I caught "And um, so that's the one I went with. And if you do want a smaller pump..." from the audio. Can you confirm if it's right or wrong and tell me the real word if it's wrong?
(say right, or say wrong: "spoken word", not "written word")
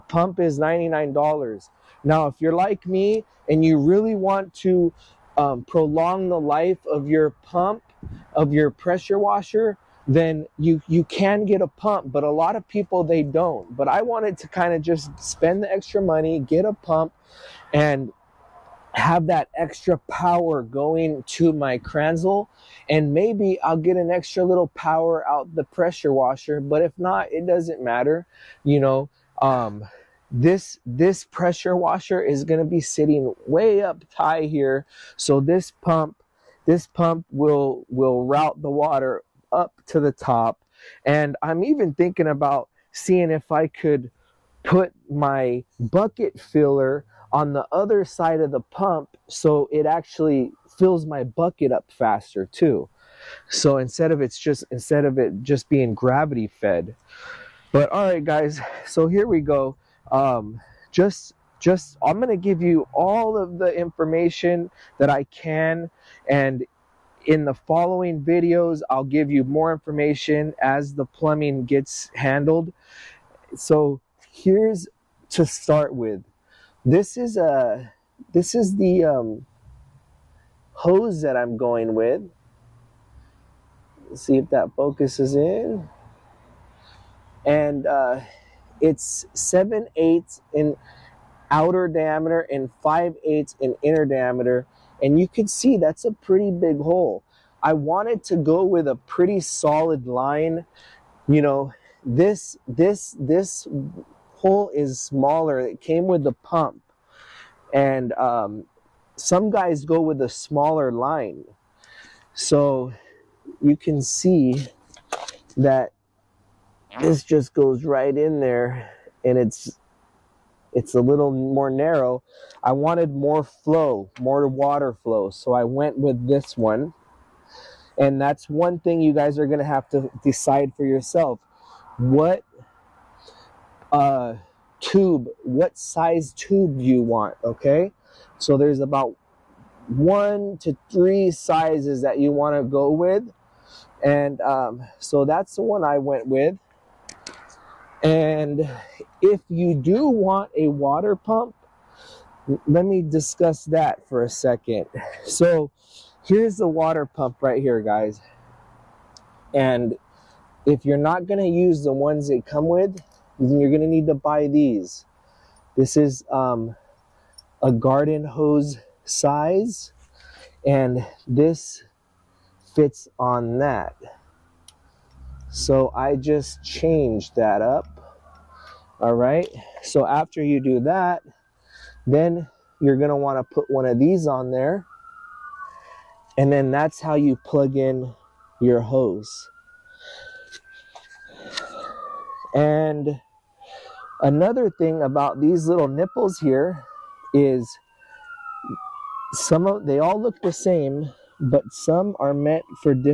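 wrong: "water", not "smaller".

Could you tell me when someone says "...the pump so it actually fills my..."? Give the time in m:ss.
0:48.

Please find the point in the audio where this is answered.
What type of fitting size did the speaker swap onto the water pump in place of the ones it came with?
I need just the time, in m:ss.
2:47.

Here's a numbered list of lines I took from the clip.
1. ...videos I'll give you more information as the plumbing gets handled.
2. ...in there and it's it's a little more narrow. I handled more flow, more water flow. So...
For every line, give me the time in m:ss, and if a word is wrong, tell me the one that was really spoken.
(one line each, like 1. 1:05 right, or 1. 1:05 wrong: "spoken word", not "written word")
1. 1:08 right
2. 1:58 wrong: "wanted", not "handled".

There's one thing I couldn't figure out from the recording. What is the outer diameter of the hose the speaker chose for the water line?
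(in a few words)
7/8 inch.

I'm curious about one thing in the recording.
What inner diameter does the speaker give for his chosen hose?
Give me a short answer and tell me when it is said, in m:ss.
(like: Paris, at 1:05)
5/8 inch, at 1:32.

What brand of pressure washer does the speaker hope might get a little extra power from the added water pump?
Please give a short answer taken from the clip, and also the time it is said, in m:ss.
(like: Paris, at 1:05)
Kranzle, at 0:21.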